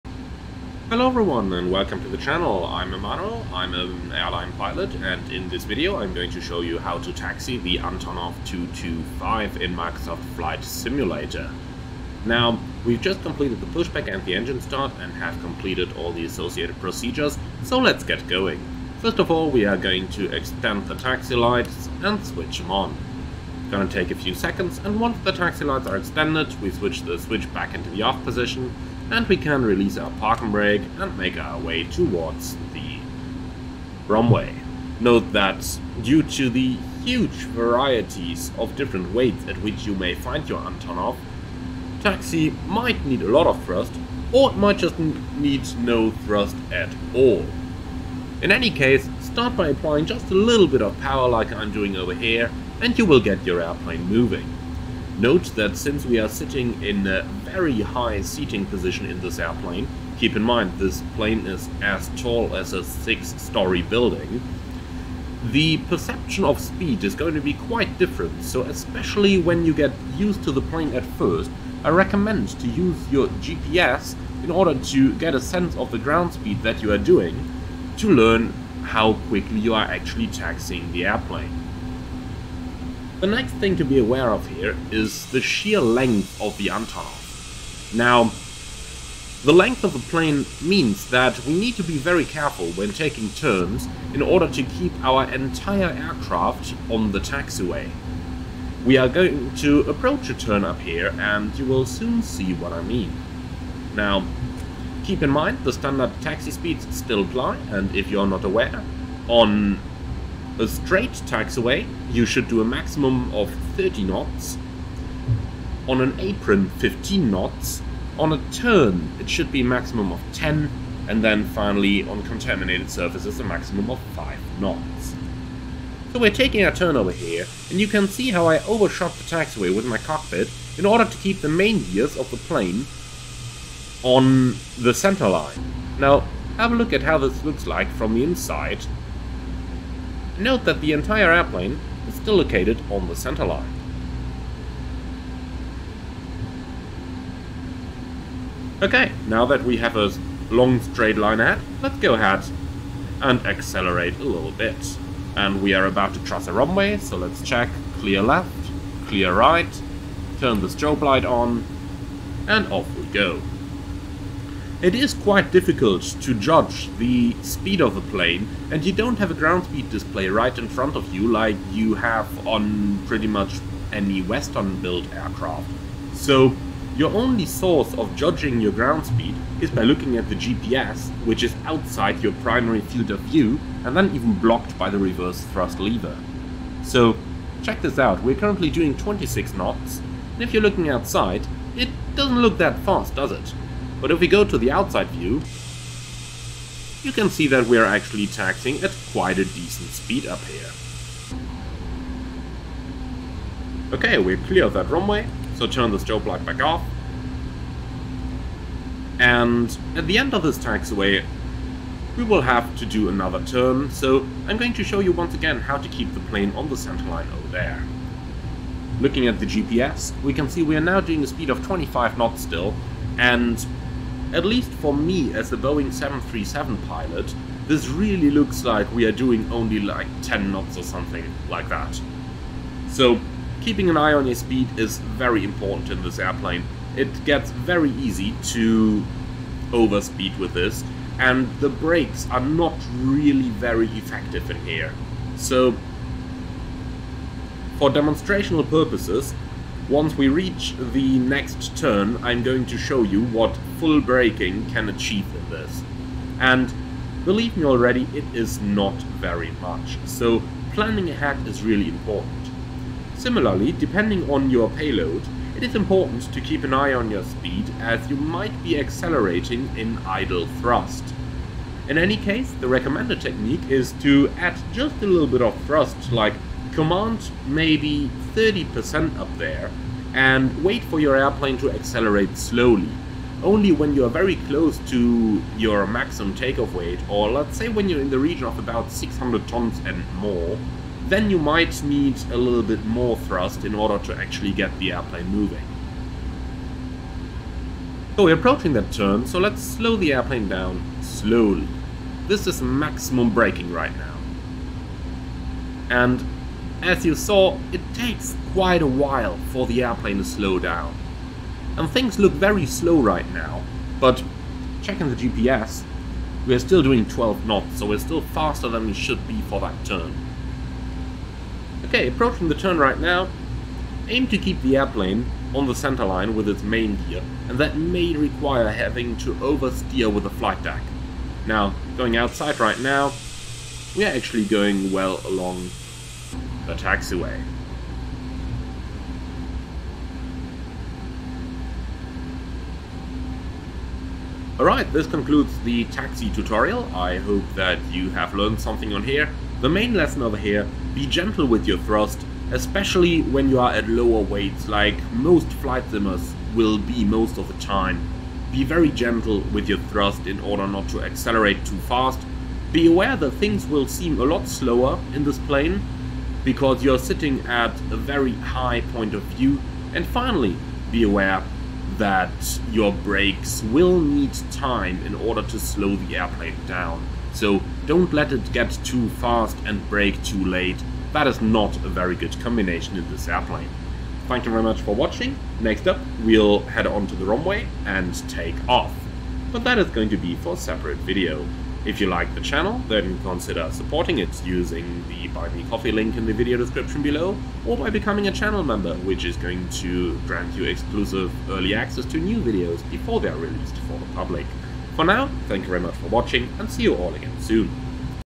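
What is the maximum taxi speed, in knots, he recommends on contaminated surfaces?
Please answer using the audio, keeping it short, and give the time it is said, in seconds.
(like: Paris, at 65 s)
5 knots, at 124 s.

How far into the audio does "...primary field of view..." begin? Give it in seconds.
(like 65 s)
182 s.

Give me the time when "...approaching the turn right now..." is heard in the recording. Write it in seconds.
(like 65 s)
322 s.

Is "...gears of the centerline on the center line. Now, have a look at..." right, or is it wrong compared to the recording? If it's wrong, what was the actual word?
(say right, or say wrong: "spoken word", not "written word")
wrong: "plane", not "centerline".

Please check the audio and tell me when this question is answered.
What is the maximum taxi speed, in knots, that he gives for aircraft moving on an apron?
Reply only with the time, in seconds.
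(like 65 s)
116 s.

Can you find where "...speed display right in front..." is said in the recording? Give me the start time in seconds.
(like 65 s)
169 s.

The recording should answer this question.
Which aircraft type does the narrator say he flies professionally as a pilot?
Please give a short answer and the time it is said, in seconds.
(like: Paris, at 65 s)
Boeing 737, at 225 s.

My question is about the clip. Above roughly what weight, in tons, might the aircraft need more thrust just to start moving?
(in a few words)
600 tons.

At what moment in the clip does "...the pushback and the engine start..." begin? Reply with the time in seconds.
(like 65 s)
13 s.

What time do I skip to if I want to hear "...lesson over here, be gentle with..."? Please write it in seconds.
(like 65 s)
349 s.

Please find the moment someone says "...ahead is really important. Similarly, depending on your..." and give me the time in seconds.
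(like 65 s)
261 s.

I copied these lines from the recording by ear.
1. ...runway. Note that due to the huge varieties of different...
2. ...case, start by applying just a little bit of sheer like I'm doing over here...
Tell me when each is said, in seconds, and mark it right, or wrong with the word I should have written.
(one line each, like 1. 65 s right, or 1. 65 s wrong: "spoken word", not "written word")
1. 34 s right
2. 48 s wrong: "power", not "sheer".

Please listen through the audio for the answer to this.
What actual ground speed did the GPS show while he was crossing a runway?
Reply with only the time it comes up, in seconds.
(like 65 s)
188 s.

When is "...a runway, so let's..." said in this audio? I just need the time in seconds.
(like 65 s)
156 s.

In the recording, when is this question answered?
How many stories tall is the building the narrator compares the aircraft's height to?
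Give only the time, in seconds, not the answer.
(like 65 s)
62 s.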